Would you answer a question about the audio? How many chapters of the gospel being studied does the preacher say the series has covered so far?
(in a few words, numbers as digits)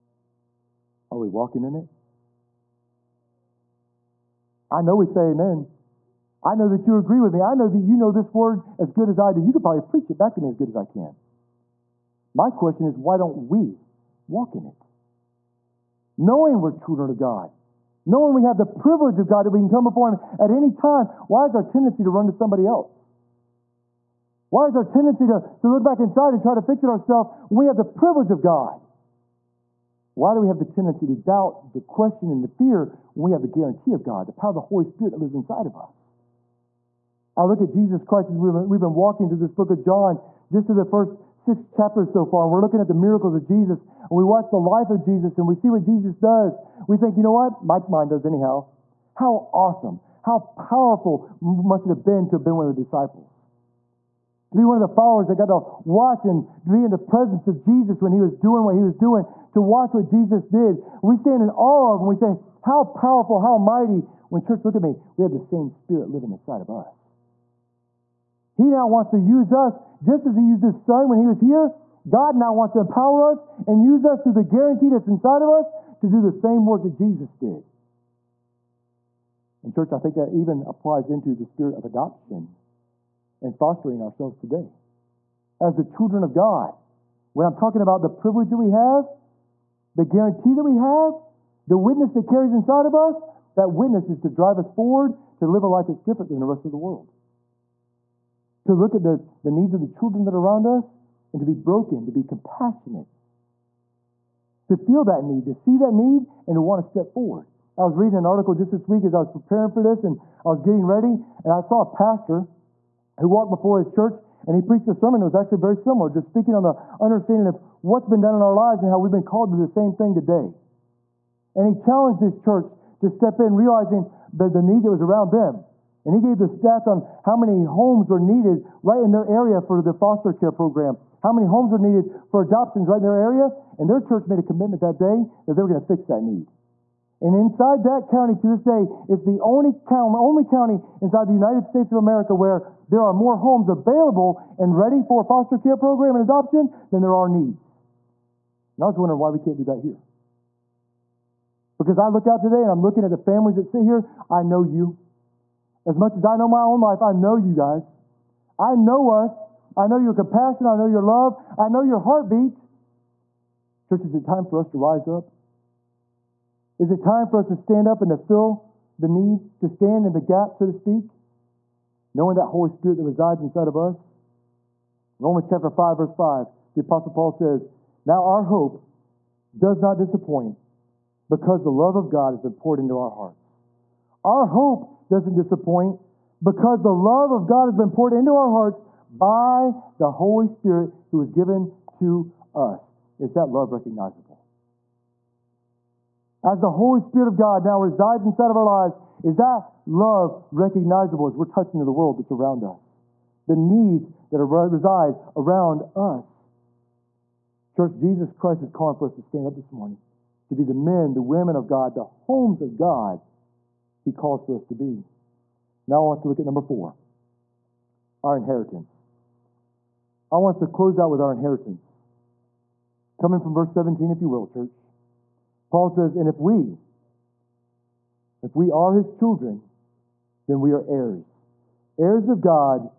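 6.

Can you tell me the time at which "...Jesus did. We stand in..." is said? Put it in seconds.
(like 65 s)
60 s.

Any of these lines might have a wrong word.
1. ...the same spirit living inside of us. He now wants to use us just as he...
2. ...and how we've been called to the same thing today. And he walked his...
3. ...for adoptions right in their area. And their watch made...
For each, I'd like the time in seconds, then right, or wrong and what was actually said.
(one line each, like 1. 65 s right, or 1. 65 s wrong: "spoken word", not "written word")
1. 65 s right
2. 118 s wrong: "challenged", not "walked"
3. 132 s wrong: "church", not "watch".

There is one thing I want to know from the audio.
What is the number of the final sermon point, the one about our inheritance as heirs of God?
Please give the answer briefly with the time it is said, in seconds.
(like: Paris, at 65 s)
4, at 216 s.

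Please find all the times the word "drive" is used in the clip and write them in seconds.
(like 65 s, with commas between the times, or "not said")
94 s.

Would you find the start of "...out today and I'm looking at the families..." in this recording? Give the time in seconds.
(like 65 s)
152 s.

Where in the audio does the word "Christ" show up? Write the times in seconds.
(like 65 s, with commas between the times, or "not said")
38 s, 208 s.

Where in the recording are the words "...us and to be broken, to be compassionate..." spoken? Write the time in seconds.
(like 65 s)
100 s.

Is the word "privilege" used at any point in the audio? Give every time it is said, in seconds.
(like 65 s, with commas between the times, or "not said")
18 s, 27 s, 88 s.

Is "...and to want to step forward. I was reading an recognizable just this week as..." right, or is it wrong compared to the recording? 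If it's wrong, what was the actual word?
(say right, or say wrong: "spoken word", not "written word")
wrong: "article", not "recognizable".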